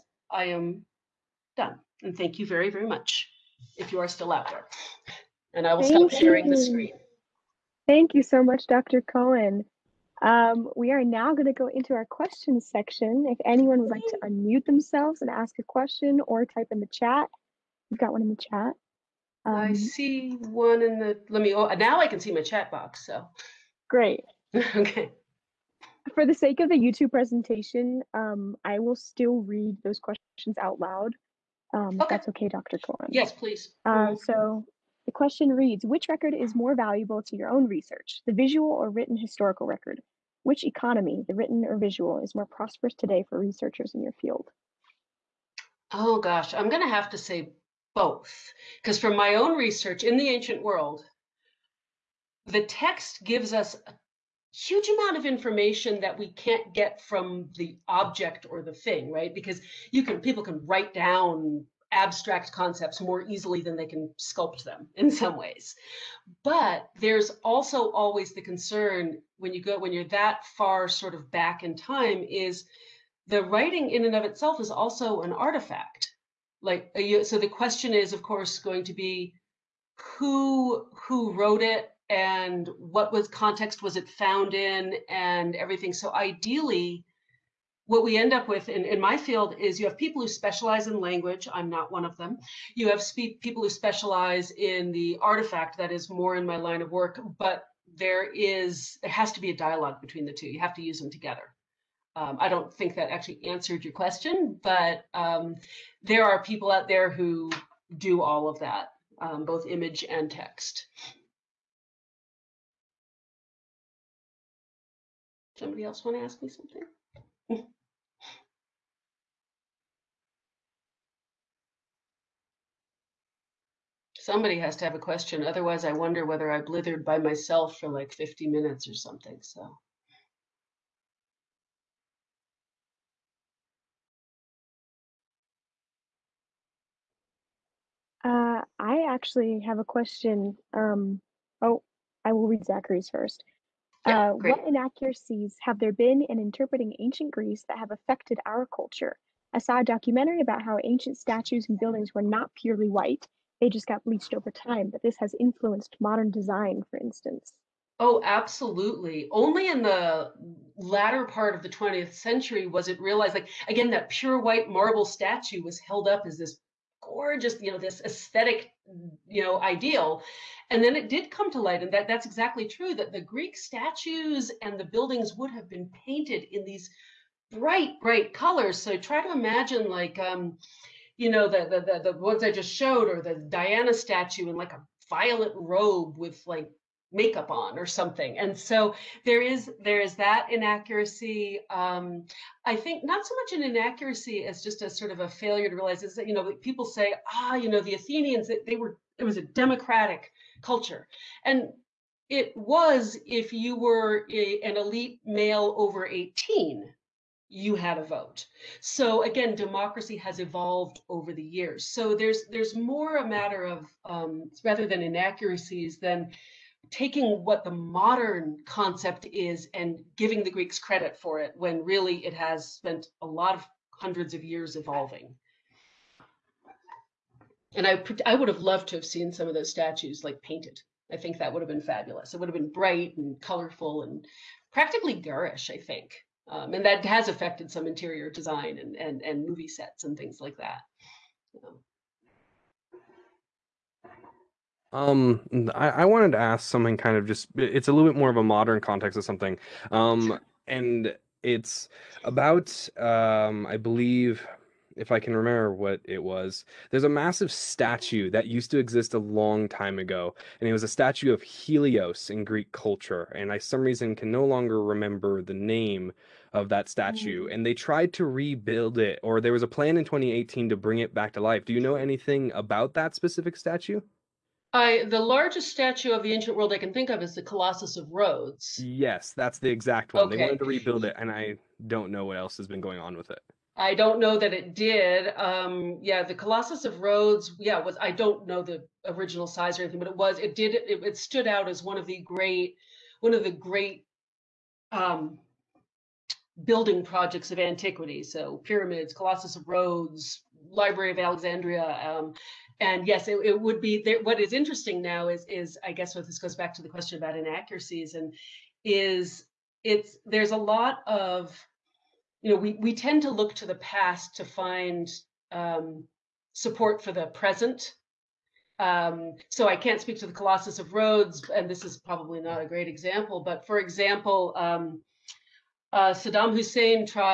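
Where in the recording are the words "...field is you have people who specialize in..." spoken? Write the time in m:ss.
1:29.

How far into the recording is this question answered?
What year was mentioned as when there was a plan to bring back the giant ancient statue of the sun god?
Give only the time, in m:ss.
4:30.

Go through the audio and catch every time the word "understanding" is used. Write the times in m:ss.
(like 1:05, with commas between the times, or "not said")
not said.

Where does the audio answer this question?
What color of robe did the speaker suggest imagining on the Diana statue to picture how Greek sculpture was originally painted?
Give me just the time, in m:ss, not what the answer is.
3:05.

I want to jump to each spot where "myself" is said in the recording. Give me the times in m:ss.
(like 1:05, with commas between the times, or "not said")
2:07.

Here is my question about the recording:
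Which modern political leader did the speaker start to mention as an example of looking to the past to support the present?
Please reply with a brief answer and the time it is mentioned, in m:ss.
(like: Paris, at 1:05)
Saddam Hussein, at 5:26.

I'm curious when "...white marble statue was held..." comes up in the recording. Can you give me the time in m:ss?
2:44.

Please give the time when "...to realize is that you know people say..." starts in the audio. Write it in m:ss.
3:15.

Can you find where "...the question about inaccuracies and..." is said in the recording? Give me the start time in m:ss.
5:06.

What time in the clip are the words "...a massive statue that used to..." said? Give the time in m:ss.
4:17.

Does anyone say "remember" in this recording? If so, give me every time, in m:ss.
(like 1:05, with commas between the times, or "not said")
4:15, 4:24.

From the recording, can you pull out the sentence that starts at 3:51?
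I think that would have been fabulous.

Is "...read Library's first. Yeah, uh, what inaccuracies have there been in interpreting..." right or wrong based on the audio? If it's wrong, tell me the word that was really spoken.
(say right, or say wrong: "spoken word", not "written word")
wrong: "Zachary", not "Library".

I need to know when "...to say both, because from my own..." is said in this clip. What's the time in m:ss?
0:47.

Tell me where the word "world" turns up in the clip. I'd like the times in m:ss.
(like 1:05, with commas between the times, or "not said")
0:50, 4:36.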